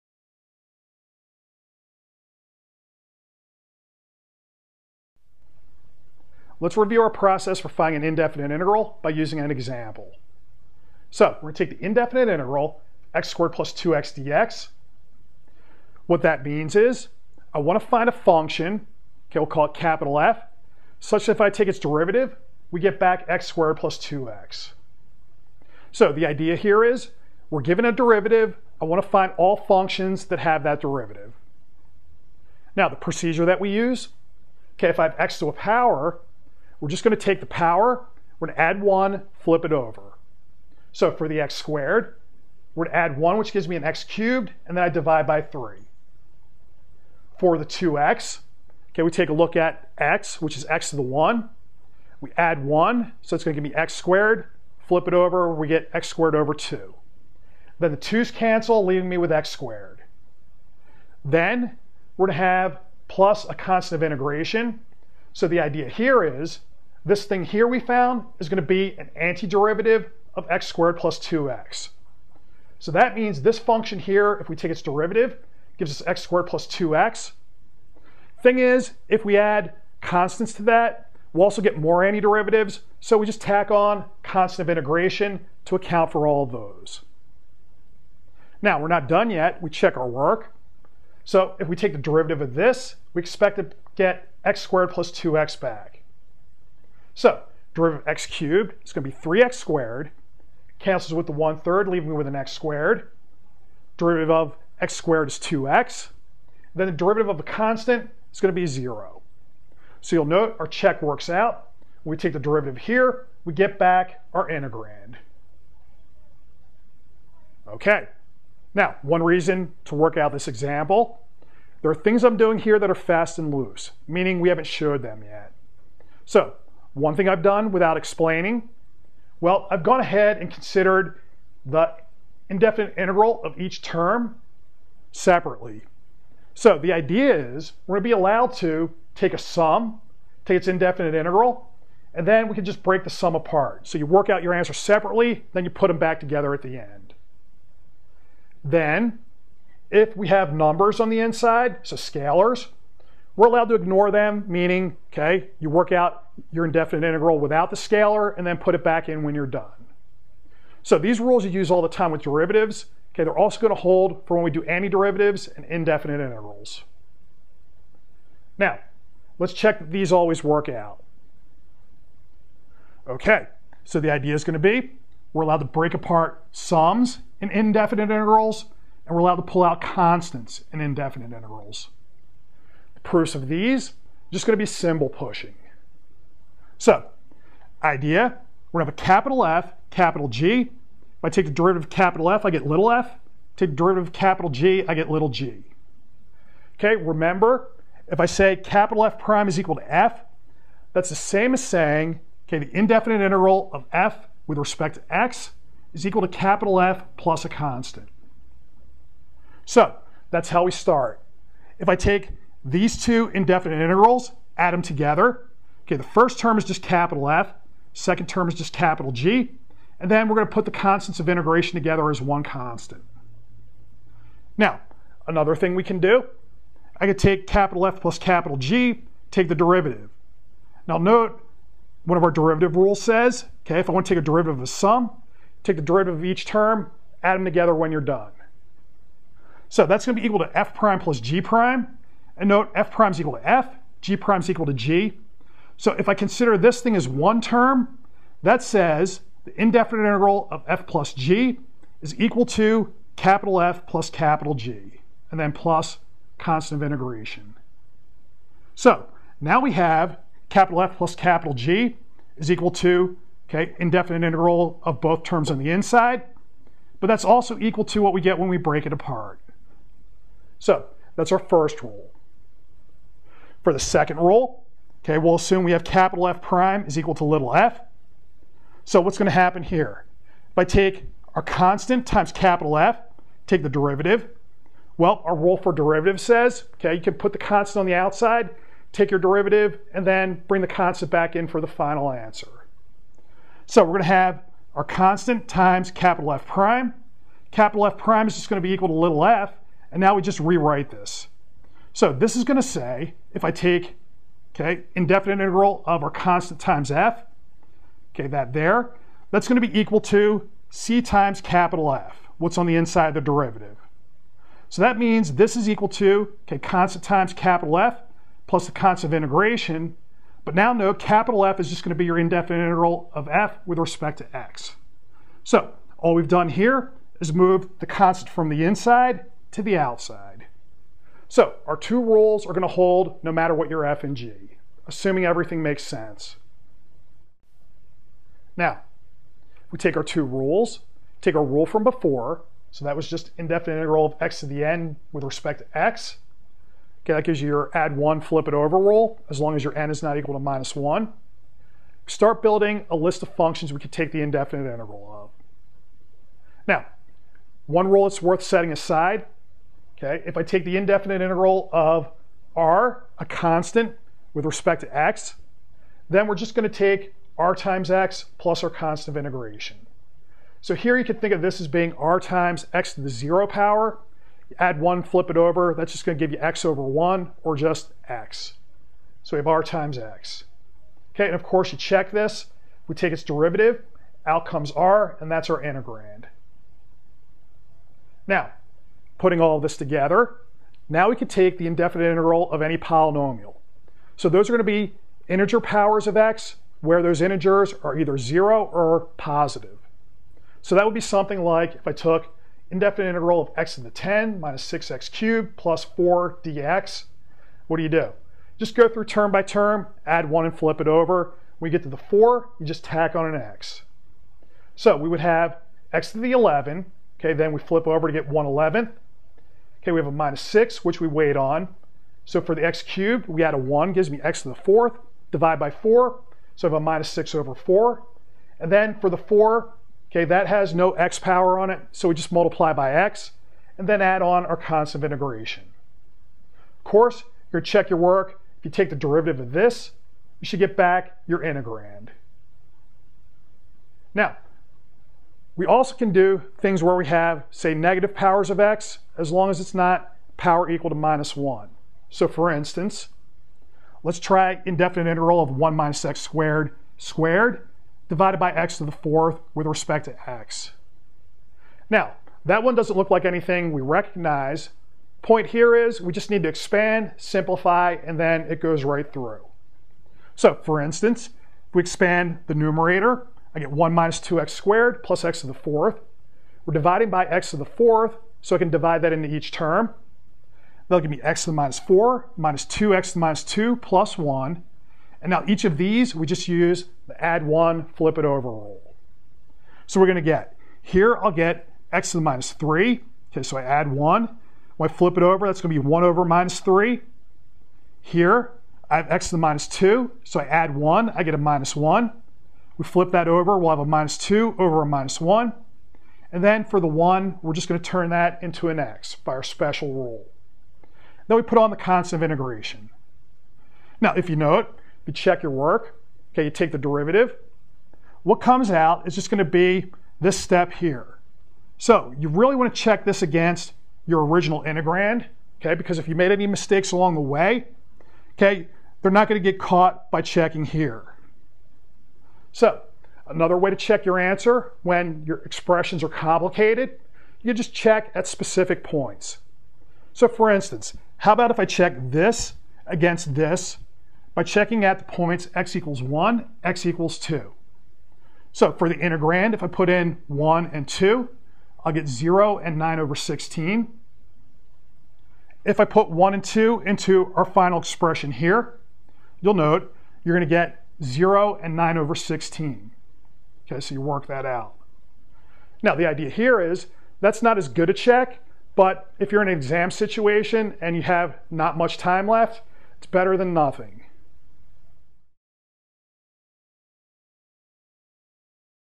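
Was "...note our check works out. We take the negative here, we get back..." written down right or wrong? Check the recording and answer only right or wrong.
wrong.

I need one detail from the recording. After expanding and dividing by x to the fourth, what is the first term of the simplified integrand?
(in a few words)
x to the minus 4.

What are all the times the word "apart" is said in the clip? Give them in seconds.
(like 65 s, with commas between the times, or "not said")
143 s, 175 s, 268 s.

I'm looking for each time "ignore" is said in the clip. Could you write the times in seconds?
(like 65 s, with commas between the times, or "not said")
153 s.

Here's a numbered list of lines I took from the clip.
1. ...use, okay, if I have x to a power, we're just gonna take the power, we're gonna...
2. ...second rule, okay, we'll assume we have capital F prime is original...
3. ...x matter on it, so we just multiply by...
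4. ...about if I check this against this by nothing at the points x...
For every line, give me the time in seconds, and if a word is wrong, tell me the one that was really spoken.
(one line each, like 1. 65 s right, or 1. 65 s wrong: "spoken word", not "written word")
1. 33 s right
2. 273 s wrong: "equal", not "original"
3. 430 s wrong: "power", not "matter"
4. 541 s wrong: "checking", not "nothing".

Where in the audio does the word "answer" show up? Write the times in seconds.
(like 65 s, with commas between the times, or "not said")
144 s, 292 s, 534 s.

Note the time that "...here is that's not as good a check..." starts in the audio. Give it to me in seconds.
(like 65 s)
566 s.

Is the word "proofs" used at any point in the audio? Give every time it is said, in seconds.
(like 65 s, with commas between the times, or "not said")
183 s.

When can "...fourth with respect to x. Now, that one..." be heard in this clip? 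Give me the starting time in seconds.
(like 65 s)
458 s.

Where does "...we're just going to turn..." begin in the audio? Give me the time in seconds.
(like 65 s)
507 s.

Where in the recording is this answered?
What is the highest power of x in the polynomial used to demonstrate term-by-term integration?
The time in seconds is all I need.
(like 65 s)
403 s.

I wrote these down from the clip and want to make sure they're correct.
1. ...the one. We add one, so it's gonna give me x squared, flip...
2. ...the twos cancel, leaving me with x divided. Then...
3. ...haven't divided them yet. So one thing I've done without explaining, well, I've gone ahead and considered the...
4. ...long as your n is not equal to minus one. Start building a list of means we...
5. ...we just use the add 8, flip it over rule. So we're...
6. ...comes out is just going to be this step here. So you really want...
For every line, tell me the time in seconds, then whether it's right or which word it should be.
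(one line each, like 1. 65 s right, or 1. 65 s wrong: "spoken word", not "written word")
1. 50 s right
2. 57 s wrong: "squared", not "divided"
3. 124 s wrong: "showed", not "divided"
4. 349 s wrong: "functions", not "means"
5. 486 s wrong: "1", not "8"
6. 518 s right.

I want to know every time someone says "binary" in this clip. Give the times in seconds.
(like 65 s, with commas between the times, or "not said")
not said.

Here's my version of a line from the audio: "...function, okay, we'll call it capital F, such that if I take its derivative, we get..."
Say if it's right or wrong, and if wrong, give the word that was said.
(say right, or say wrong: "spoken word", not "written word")
right.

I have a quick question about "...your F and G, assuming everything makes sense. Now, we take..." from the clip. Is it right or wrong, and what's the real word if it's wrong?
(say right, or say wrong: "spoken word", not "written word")
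right.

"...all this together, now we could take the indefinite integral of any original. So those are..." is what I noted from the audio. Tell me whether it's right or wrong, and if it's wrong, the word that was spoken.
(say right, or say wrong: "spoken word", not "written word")
wrong: "polynomial", not "original".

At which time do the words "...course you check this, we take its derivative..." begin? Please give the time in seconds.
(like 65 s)
381 s.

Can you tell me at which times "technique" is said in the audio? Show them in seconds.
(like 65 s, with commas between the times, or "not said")
not said.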